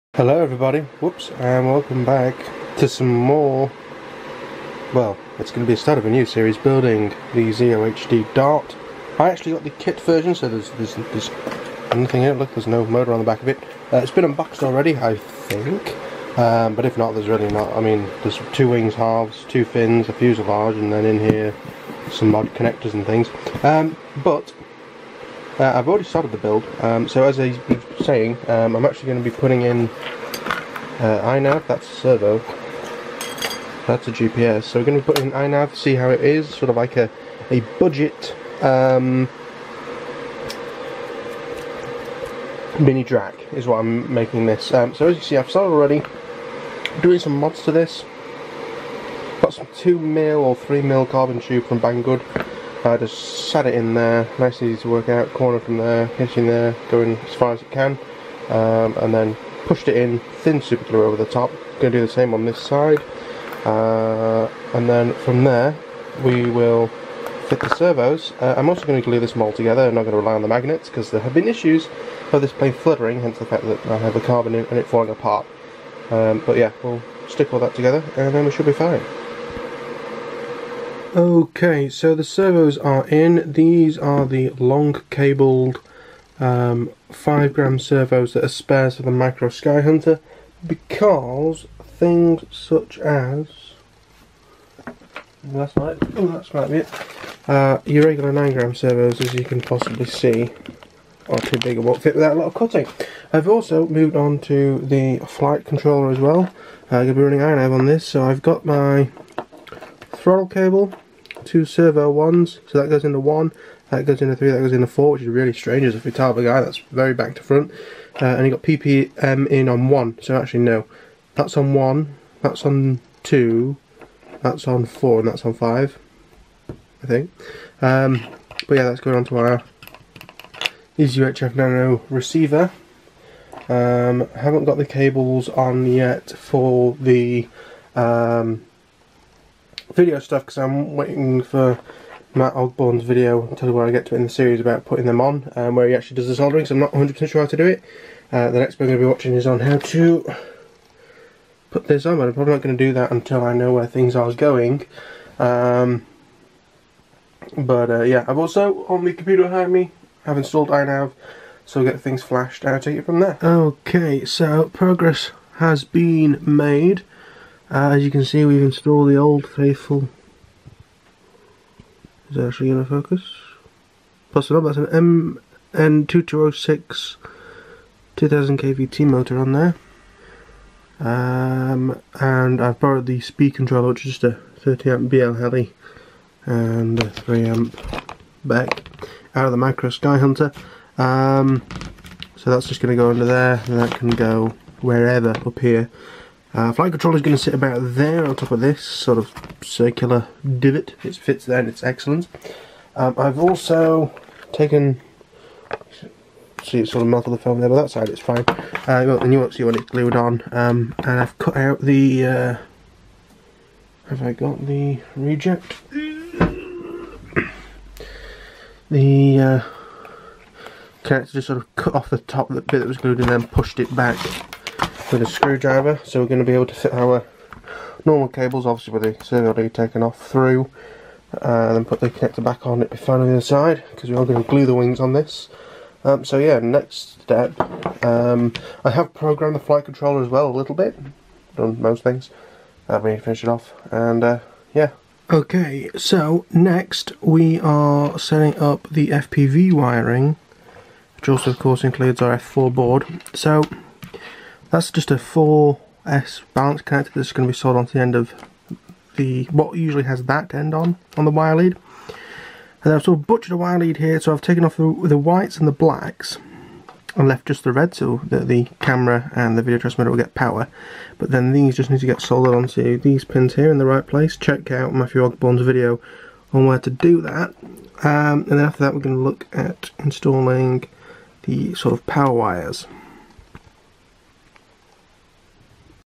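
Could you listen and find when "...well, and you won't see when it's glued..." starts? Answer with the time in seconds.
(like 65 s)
209 s.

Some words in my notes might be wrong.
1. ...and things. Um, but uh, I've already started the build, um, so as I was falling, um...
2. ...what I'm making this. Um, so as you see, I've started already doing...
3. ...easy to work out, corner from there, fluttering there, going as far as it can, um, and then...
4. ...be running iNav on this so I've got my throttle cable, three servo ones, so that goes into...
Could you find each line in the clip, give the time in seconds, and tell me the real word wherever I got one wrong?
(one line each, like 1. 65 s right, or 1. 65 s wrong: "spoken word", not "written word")
1. 22 s wrong: "saying", not "falling"
2. 43 s right
3. 54 s wrong: "pinching", not "fluttering"
4. 107 s wrong: "two", not "three".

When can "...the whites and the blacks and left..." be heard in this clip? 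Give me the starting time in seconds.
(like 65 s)
265 s.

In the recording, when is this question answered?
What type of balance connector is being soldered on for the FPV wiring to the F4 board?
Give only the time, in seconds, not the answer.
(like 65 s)
255 s.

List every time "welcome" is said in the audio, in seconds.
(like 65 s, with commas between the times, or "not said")
1 s.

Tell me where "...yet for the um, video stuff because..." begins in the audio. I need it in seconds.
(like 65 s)
135 s.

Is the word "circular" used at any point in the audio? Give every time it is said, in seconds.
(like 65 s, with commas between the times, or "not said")
199 s.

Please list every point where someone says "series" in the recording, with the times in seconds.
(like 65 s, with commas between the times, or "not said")
6 s, 144 s.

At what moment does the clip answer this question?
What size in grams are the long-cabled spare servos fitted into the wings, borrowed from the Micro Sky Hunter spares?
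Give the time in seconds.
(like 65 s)
87 s.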